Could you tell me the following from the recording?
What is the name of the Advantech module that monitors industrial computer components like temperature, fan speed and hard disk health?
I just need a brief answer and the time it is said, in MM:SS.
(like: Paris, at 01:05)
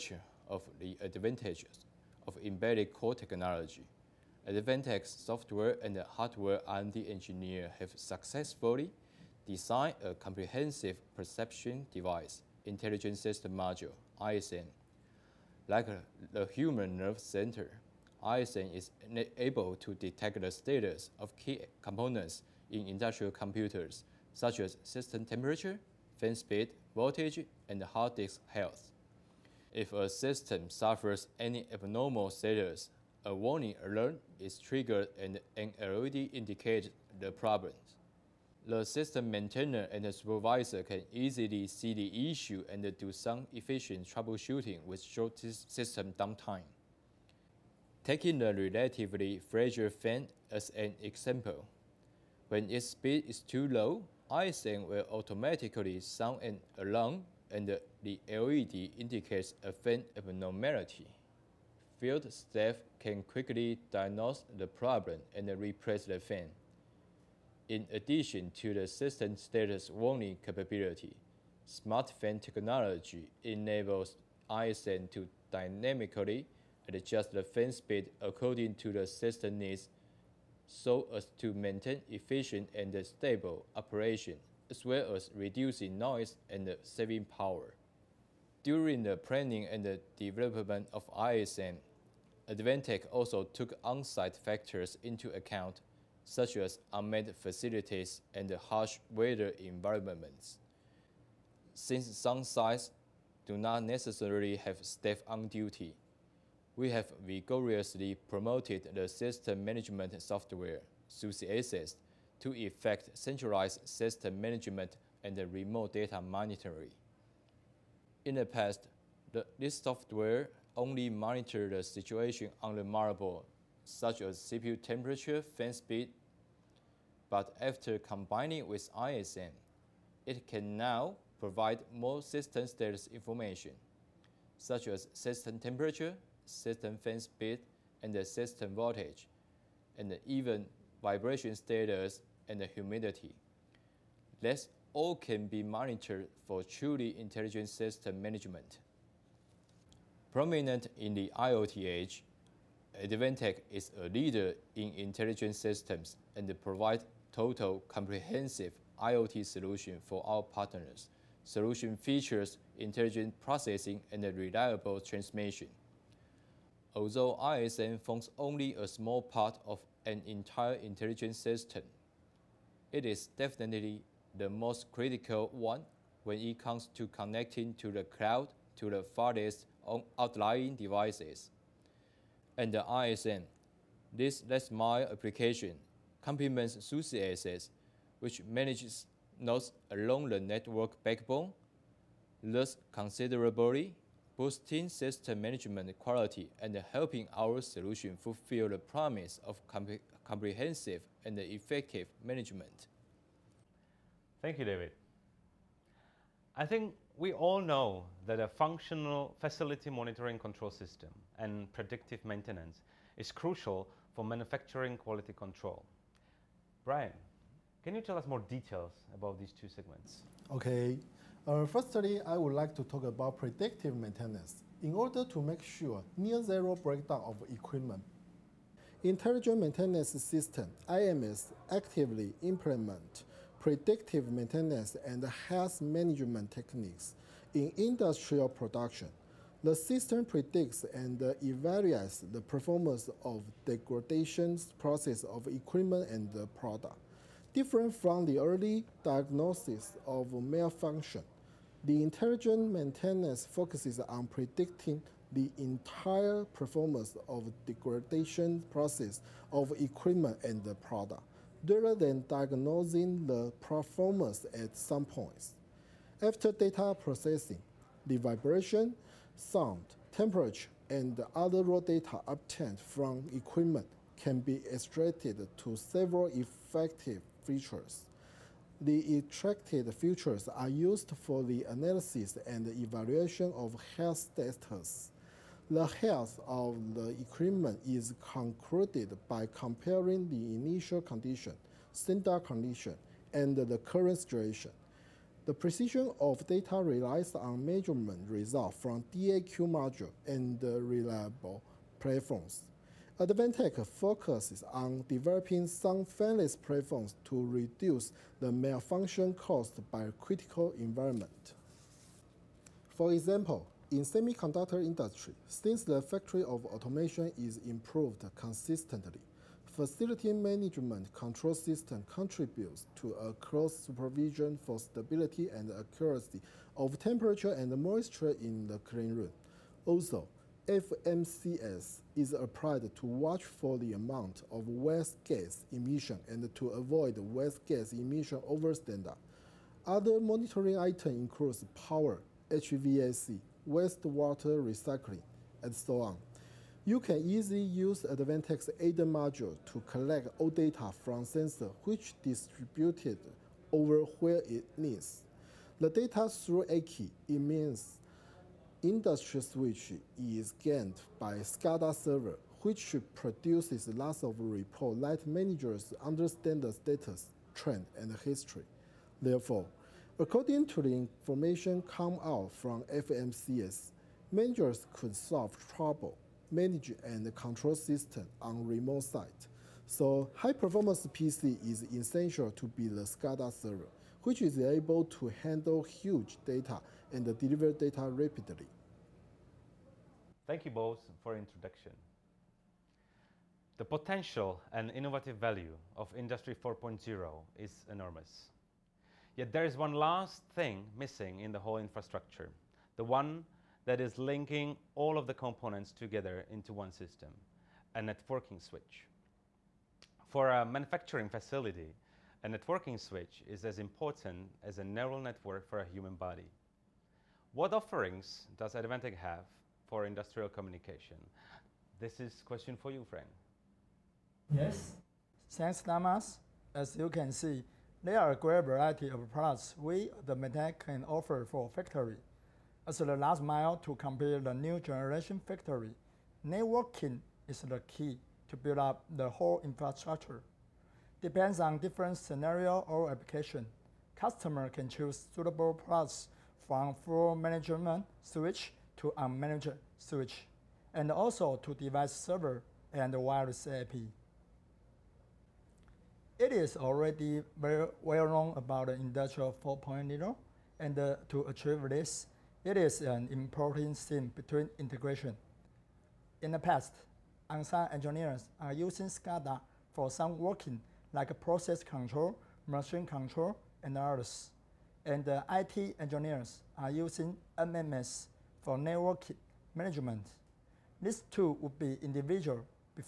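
intelligent system module, at 00:12.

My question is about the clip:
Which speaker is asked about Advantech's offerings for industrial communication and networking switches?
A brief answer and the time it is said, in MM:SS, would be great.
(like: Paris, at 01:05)
Frank, at 07:03.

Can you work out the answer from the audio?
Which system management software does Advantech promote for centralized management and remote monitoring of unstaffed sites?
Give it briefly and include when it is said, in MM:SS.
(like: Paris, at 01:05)
SUSIAccess, at 01:51.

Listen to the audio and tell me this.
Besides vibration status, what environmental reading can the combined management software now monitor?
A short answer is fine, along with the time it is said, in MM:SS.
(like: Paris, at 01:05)
humidity, at 02:22.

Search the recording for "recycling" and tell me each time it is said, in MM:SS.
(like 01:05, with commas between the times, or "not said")
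05:44.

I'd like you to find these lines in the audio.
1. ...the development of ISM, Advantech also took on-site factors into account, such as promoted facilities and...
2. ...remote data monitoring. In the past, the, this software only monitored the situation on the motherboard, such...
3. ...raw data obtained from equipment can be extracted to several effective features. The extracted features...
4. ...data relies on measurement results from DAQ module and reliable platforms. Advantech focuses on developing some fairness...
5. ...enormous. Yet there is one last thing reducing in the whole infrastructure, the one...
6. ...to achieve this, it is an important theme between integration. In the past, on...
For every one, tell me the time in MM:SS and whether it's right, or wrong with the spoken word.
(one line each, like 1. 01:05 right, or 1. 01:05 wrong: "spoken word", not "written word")
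1. 01:29 wrong: "unmanned", not "promoted"
2. 01:55 right
3. 04:31 right
4. 04:56 right
5. 06:37 wrong: "missing", not "reducing"
6. 07:41 right.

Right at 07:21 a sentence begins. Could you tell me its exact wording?
Depends on different scenario or application.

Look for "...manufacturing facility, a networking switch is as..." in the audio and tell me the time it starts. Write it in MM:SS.
06:50.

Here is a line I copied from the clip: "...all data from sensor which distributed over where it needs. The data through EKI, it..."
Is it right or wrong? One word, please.
right.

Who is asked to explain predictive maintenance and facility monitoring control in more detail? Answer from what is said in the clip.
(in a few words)
Brian.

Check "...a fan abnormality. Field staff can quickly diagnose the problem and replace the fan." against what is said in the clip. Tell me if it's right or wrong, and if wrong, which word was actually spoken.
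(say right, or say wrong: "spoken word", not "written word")
right.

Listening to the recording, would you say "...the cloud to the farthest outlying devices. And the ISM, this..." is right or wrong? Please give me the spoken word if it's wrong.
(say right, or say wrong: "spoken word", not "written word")
right.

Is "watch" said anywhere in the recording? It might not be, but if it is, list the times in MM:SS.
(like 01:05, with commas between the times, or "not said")
05:33.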